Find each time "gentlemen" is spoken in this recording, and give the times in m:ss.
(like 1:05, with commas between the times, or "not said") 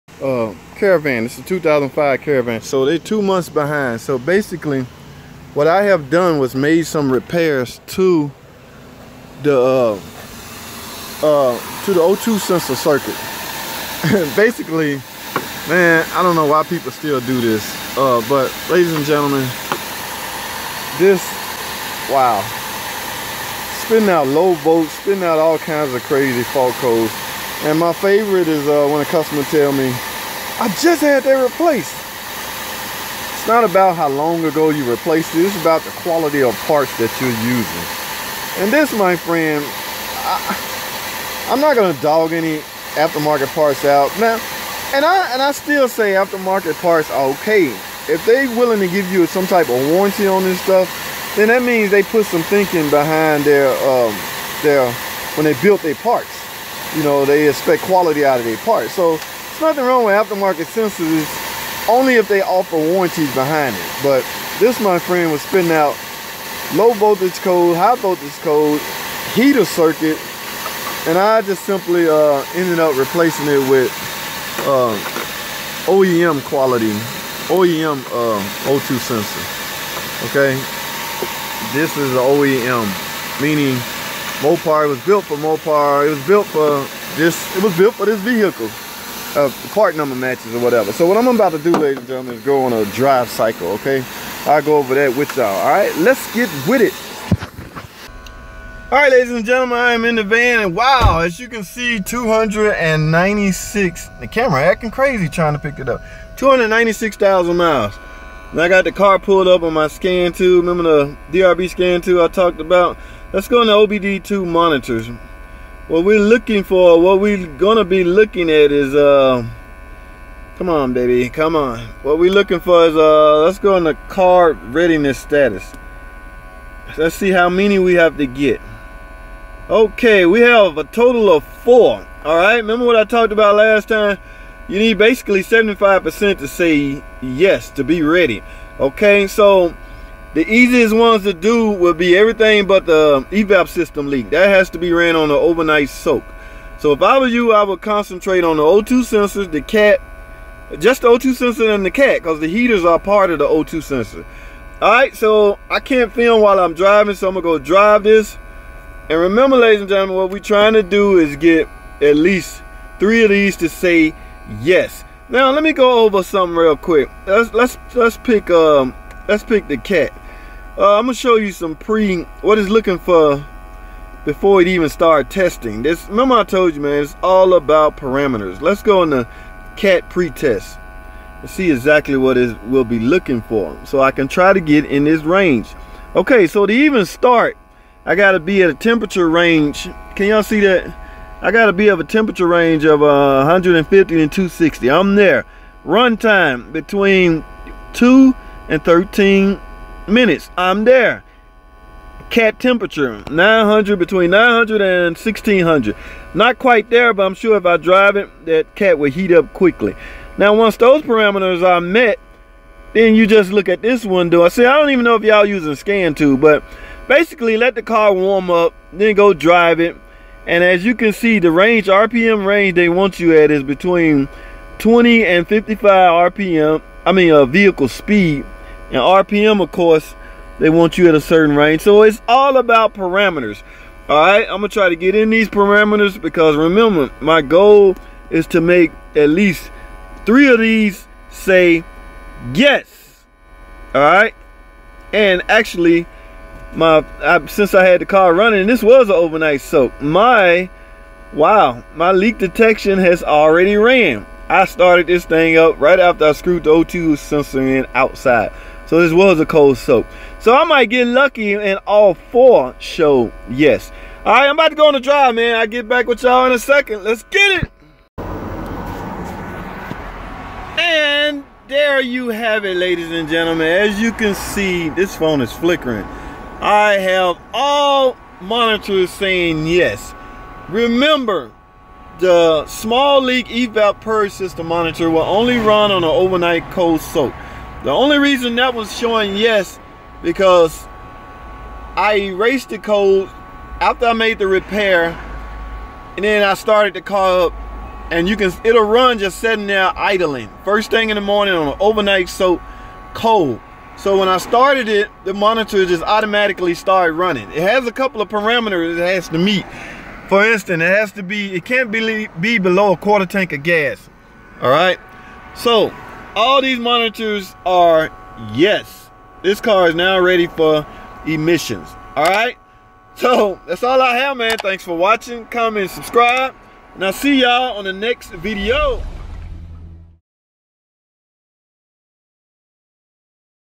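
0:19, 1:32, 1:39, 2:39, 4:33.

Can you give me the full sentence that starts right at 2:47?
Let's, let's, let's, pick, um, let's pick the cat.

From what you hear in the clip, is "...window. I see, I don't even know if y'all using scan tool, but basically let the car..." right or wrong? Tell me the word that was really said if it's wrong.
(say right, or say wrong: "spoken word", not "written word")
right.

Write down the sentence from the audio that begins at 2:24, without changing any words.
That has to be ran on an overnight soak.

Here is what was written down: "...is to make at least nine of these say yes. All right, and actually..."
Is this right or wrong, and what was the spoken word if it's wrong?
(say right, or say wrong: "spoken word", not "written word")
wrong: "three", not "nine".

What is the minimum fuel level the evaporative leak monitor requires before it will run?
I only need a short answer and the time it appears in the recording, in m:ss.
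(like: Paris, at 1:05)
a quarter tank, at 5:12.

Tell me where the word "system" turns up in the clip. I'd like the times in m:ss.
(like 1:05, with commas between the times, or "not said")
2:23, 4:44.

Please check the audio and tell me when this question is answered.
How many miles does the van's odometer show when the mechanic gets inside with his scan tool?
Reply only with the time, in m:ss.
1:46.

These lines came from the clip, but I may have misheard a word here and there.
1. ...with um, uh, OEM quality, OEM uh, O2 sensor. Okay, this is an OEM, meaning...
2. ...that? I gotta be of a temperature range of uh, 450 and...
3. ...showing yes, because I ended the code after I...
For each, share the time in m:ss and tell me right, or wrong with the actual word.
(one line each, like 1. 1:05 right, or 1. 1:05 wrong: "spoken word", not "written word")
1. 1:13 right
2. 3:10 wrong: "150", not "450"
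3. 4:48 wrong: "erased", not "ended".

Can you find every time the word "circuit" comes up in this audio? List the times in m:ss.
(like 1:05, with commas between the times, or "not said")
0:12, 1:09.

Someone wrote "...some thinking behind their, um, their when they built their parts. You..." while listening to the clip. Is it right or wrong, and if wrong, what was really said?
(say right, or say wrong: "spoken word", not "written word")
right.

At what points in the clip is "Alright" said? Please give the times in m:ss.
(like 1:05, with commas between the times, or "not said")
2:12, 2:34.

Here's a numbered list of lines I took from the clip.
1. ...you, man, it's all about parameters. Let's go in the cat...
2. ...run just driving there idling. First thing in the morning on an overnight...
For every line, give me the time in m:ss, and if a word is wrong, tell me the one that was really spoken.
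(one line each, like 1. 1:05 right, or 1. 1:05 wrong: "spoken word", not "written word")
1. 2:56 right
2. 4:58 wrong: "sitting", not "driving".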